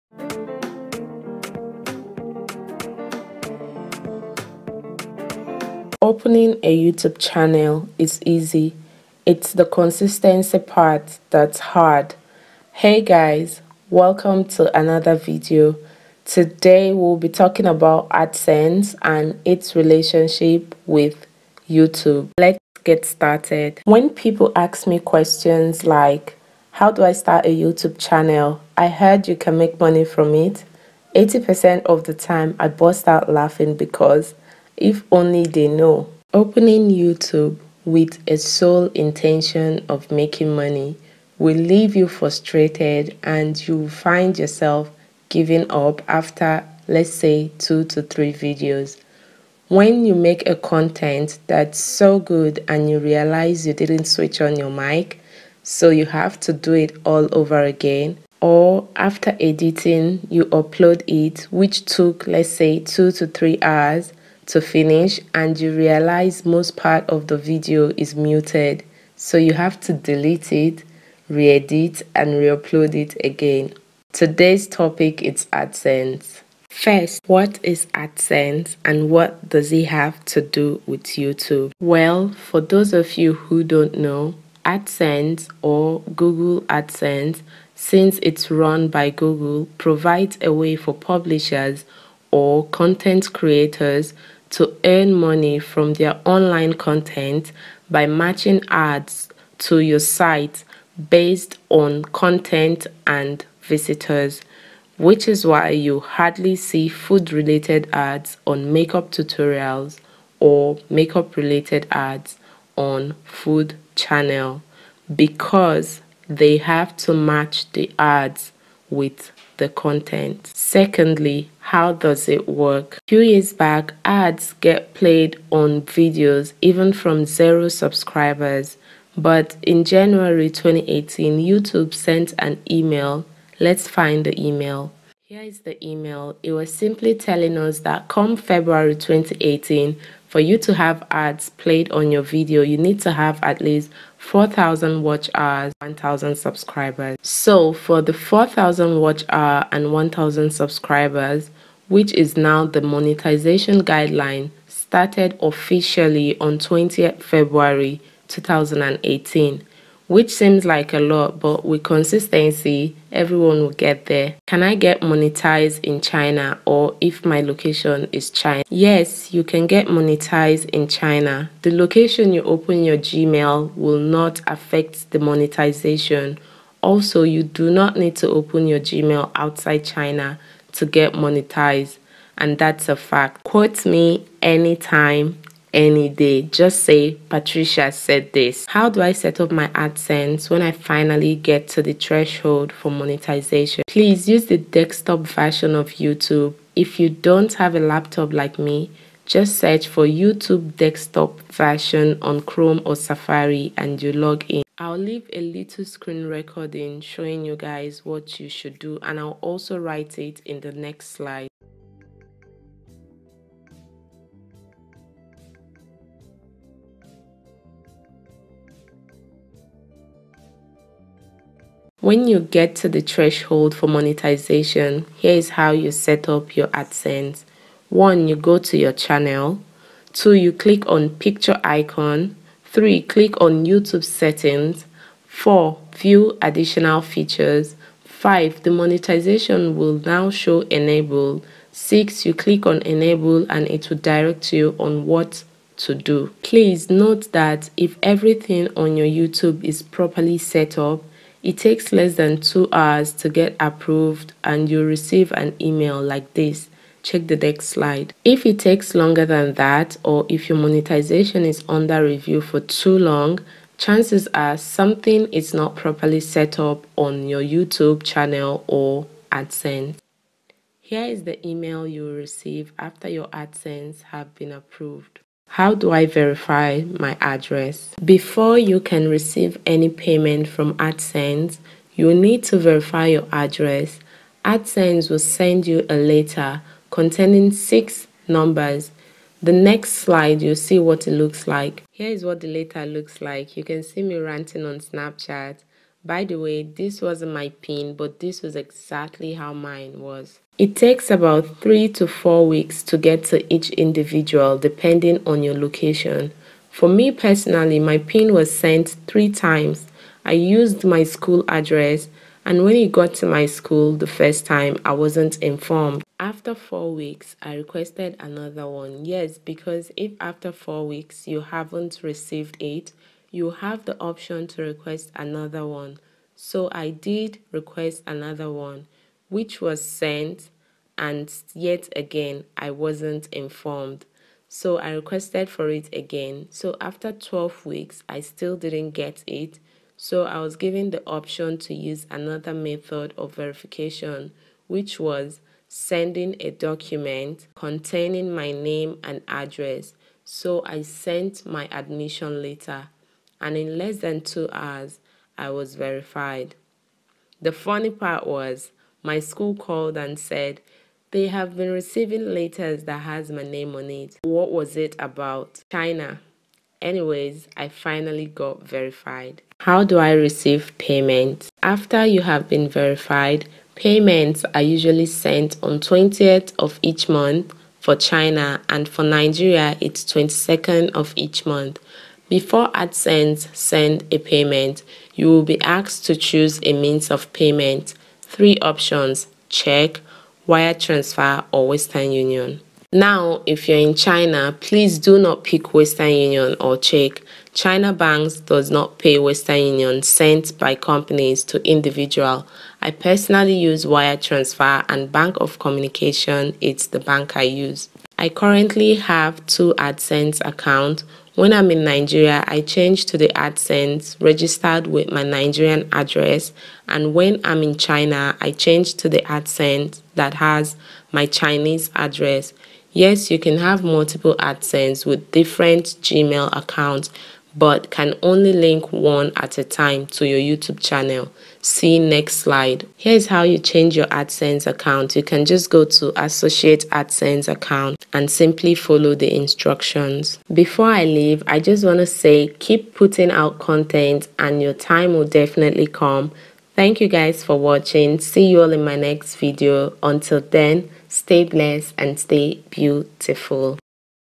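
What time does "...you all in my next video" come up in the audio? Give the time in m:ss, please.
7:28.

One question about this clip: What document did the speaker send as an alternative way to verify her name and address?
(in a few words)
Admission letter.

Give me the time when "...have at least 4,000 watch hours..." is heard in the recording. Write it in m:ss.
2:23.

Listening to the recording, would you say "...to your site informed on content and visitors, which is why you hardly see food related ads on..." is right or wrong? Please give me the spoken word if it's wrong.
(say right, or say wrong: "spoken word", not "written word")
wrong: "based", not "informed".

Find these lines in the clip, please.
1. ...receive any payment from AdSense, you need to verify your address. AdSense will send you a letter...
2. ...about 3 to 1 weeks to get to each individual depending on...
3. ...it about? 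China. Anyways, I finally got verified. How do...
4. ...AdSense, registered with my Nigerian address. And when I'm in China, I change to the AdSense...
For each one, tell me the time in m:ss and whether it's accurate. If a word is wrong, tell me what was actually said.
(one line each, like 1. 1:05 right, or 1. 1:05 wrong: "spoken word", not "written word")
1. 4:39 right
2. 5:01 wrong: "4", not "1"
3. 6:04 right
4. 6:53 right.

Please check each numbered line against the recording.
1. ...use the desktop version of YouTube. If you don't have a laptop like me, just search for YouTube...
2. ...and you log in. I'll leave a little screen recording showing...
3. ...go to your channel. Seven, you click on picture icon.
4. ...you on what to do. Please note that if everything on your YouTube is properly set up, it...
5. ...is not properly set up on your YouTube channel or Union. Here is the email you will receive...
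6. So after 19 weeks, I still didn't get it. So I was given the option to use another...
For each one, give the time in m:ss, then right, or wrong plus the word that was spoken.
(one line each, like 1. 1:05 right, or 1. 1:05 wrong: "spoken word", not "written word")
1. 3:14 right
2. 3:23 right
3. 3:48 wrong: "Two", not "Seven"
4. 4:04 right
5. 4:25 wrong: "AdSense", not "Union"
6. 5:36 wrong: "12", not "19".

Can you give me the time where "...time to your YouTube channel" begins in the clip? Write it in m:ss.
7:09.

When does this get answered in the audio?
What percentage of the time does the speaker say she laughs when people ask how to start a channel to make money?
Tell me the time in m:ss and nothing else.
0:31.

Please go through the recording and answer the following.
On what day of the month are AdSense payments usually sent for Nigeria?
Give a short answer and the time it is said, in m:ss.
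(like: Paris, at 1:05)
22nd, at 6:20.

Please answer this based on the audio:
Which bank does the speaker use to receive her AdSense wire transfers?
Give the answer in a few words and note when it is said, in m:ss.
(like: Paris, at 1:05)
Bank of Communication, at 6:45.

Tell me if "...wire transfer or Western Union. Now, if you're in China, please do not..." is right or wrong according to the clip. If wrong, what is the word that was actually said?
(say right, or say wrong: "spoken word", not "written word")
right.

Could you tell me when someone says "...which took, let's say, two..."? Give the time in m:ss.
1:01.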